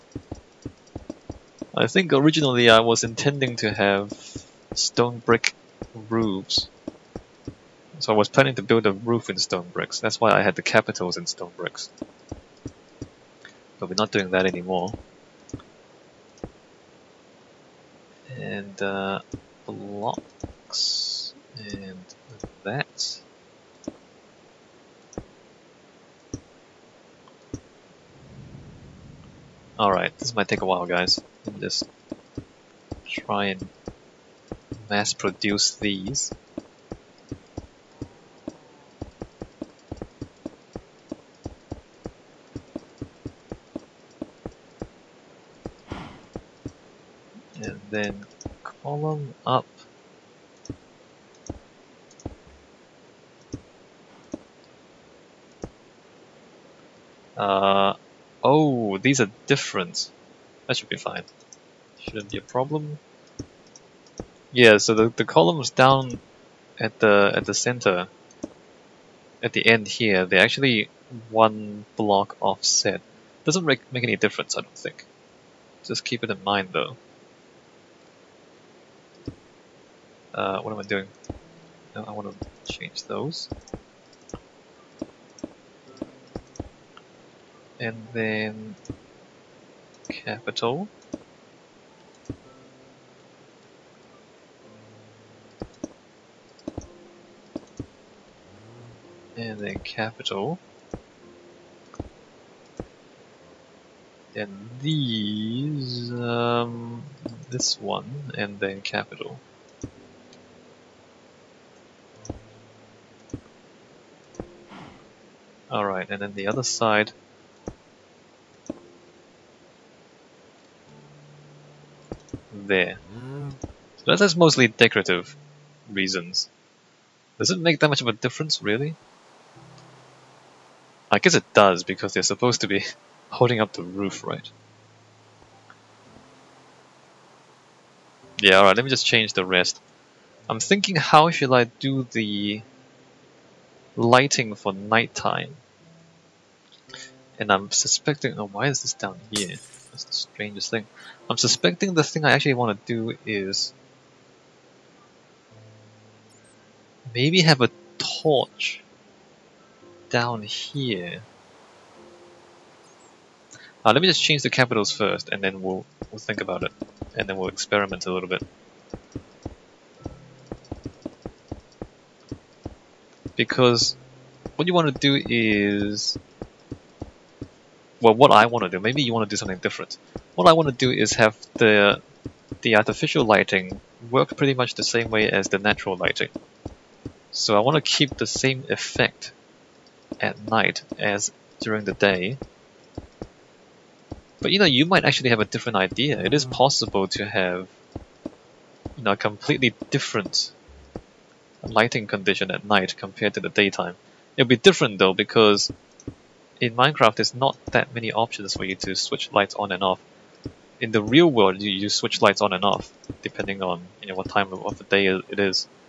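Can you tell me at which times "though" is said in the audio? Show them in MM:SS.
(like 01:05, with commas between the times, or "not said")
01:16, 03:24.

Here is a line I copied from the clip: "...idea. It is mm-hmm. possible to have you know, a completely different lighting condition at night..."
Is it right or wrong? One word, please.
right.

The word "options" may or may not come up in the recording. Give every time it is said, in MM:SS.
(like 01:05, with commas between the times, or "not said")
03:28.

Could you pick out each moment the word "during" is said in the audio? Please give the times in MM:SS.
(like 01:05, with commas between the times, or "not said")
03:11.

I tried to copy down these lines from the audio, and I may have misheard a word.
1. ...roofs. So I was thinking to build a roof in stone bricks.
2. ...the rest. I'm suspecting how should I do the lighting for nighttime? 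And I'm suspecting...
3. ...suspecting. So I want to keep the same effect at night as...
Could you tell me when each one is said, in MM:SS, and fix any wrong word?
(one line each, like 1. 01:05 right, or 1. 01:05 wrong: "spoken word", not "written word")
1. 00:06 wrong: "planning", not "thinking"
2. 02:19 wrong: "thinking", not "suspecting"
3. 03:05 wrong: "lighting", not "suspecting".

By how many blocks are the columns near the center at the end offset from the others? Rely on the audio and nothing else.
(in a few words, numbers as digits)
1.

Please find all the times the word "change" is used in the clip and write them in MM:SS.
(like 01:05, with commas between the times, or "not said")
01:22, 02:19, 02:44.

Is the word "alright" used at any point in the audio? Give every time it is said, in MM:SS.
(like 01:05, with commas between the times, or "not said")
00:29, 01:55, 02:18.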